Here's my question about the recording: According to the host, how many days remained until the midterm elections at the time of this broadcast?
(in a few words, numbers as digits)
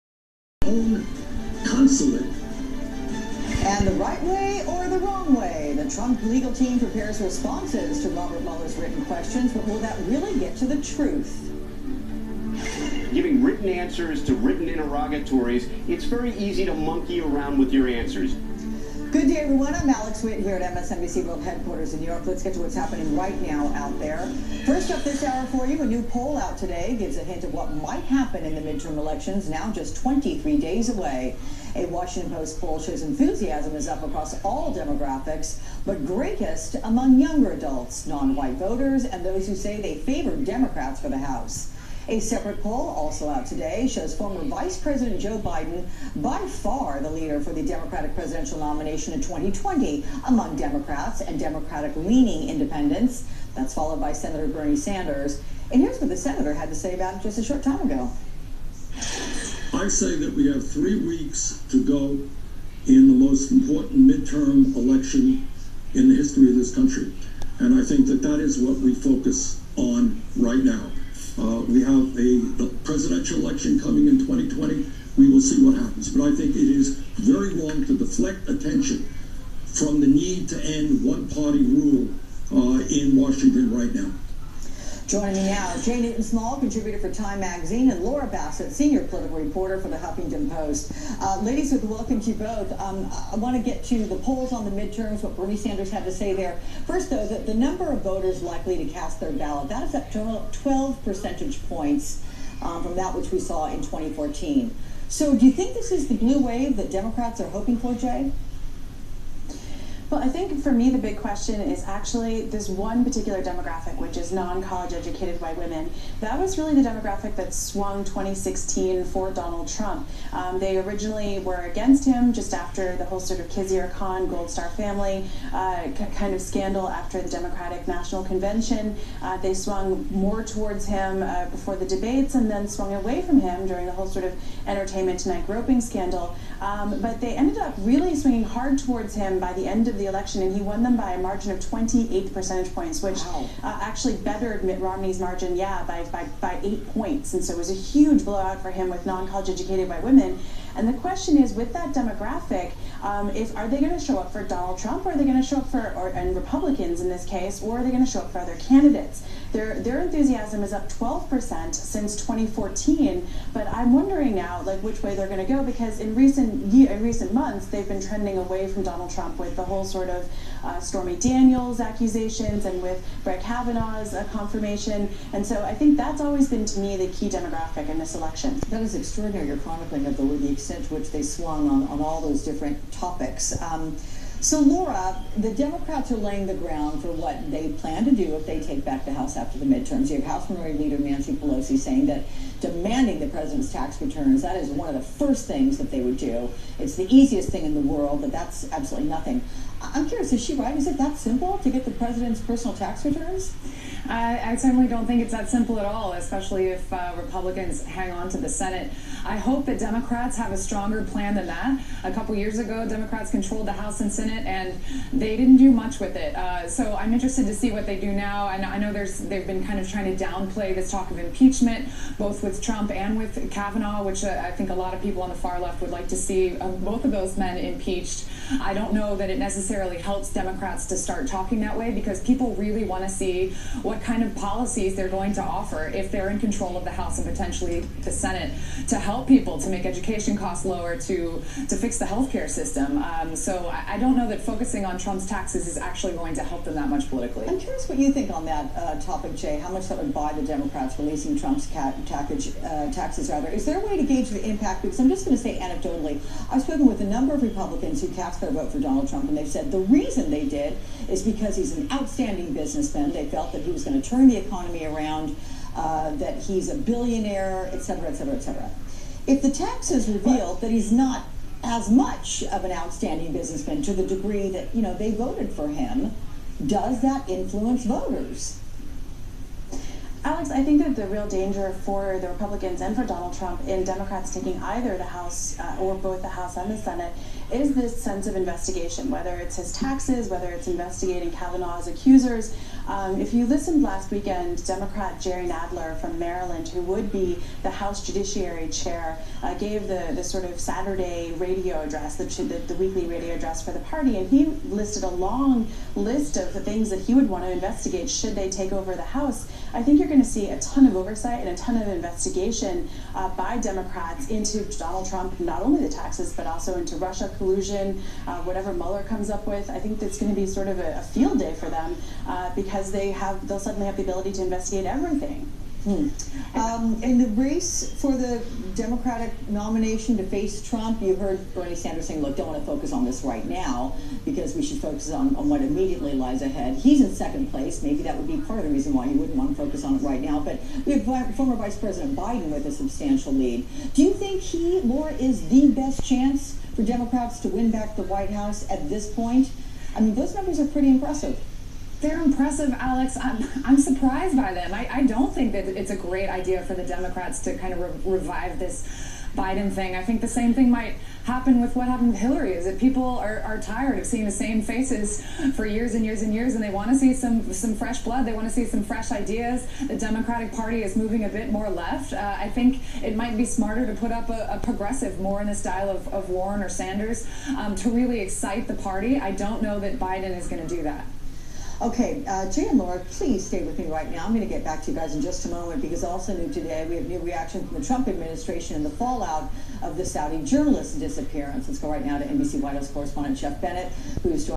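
23.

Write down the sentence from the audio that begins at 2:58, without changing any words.
That is extraordinary your chronicling of the, the extent to which they swung on, on all those different topics.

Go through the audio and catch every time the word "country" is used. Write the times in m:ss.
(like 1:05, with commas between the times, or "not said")
1:06.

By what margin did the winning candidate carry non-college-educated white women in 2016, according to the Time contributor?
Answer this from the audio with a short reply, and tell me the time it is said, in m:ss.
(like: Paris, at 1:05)
28 percentage points, at 2:21.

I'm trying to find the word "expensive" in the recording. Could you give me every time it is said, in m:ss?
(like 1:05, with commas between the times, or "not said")
not said.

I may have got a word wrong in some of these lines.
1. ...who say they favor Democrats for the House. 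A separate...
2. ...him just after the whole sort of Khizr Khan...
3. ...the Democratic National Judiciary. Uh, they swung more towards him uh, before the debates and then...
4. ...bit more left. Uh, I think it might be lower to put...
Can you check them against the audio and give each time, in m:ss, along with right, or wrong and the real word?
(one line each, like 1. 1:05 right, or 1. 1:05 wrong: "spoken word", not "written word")
1. 0:39 right
2. 2:02 right
3. 2:07 wrong: "Convention", not "Judiciary"
4. 6:11 wrong: "smarter", not "lower".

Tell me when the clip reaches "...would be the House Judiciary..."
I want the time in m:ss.
4:56.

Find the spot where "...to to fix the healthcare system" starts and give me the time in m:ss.
4:00.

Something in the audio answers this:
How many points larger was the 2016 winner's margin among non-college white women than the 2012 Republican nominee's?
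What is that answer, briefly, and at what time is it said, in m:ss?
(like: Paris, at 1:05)
8, at 2:26.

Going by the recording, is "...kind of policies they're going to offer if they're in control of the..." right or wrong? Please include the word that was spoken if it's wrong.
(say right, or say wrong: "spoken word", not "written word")
right.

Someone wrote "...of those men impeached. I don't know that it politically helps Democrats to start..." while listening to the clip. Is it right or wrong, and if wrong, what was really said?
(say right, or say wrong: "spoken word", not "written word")
wrong: "necessarily", not "politically".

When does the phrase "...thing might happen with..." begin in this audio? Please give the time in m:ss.
6:00.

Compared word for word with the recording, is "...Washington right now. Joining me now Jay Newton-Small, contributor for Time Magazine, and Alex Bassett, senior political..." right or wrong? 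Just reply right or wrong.
wrong.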